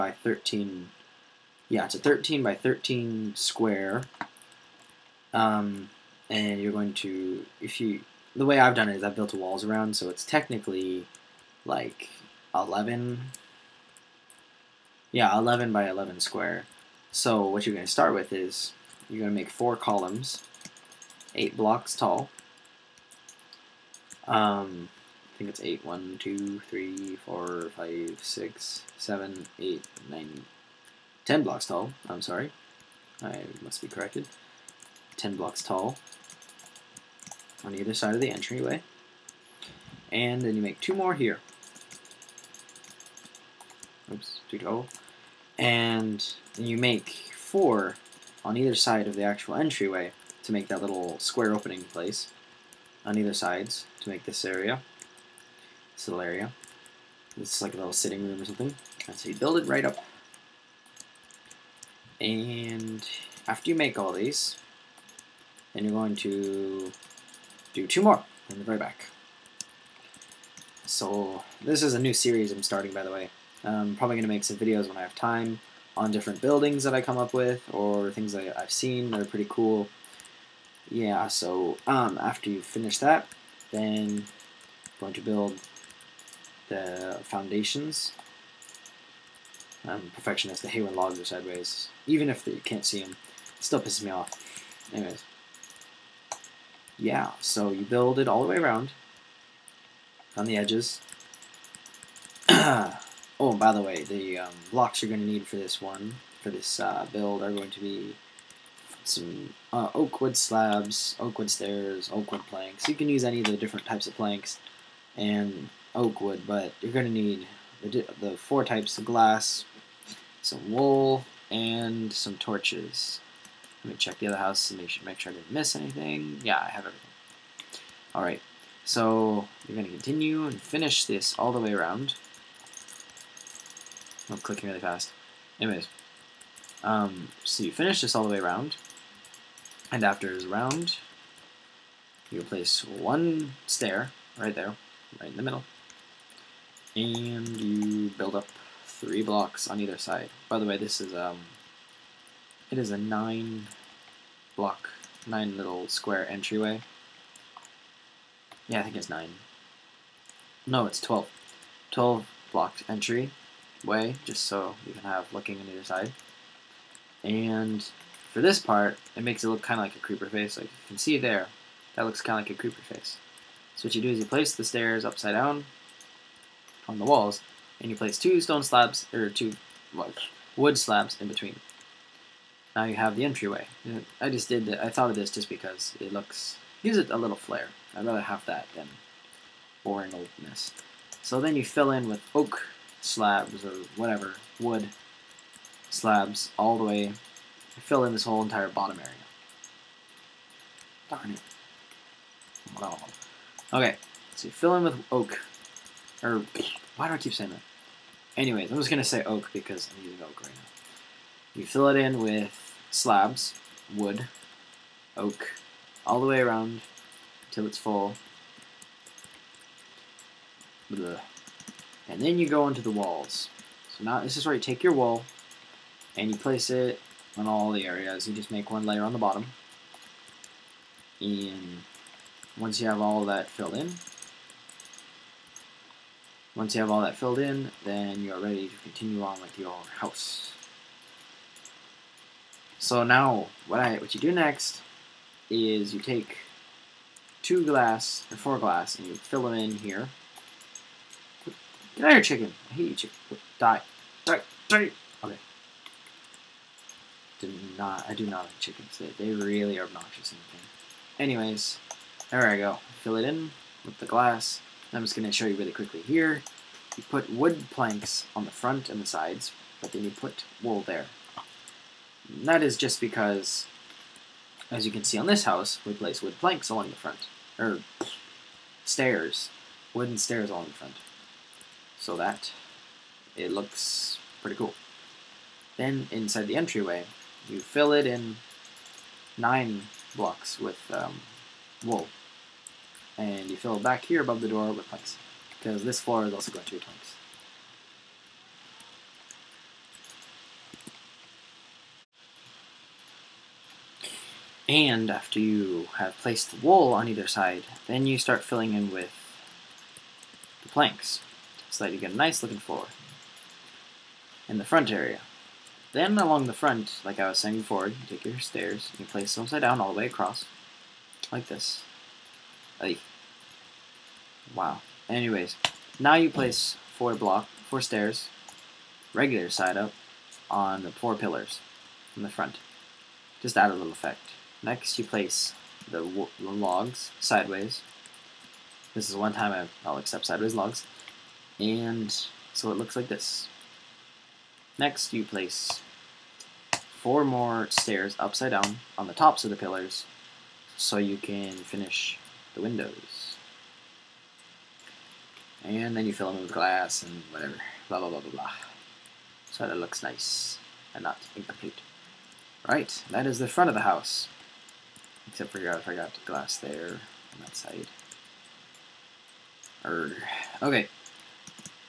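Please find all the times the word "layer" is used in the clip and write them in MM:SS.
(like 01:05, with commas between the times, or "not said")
03:48.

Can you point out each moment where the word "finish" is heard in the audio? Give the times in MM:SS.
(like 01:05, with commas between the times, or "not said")
01:22, 02:10, 02:17, 05:51.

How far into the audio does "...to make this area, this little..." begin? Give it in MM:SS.
00:54.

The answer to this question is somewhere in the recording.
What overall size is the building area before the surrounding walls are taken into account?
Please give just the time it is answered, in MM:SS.
00:01.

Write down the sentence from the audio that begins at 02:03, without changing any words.
Let me check the other house and make sure, make sure I didn't miss anything.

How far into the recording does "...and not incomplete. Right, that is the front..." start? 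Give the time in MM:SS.
06:00.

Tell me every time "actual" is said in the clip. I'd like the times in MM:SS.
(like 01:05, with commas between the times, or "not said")
00:49.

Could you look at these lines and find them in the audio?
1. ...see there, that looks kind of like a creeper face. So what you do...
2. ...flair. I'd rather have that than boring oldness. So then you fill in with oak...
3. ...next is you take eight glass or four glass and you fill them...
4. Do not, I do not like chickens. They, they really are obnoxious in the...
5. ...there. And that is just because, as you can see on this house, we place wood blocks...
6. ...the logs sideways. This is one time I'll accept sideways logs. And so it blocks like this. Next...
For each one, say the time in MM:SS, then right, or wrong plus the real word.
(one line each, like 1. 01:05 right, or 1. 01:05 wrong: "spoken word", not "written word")
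1. 02:50 right
2. 03:07 right
3. 04:04 wrong: "two", not "eight"
4. 04:17 right
5. 04:30 wrong: "planks", not "blocks"
6. 05:36 wrong: "looks", not "blocks".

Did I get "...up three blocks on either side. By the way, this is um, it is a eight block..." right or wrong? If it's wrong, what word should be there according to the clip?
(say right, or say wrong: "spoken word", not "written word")
wrong: "nine", not "eight".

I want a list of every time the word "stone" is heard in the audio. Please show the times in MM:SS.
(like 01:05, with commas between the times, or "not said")
02:58.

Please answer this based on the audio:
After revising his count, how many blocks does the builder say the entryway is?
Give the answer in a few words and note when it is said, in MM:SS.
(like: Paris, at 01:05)
12, at 02:41.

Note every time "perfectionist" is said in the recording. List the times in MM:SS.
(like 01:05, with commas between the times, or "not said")
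01:30.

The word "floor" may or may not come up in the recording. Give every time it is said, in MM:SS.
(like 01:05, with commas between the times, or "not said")
04:55, 05:12.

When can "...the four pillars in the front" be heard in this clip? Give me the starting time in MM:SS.
05:30.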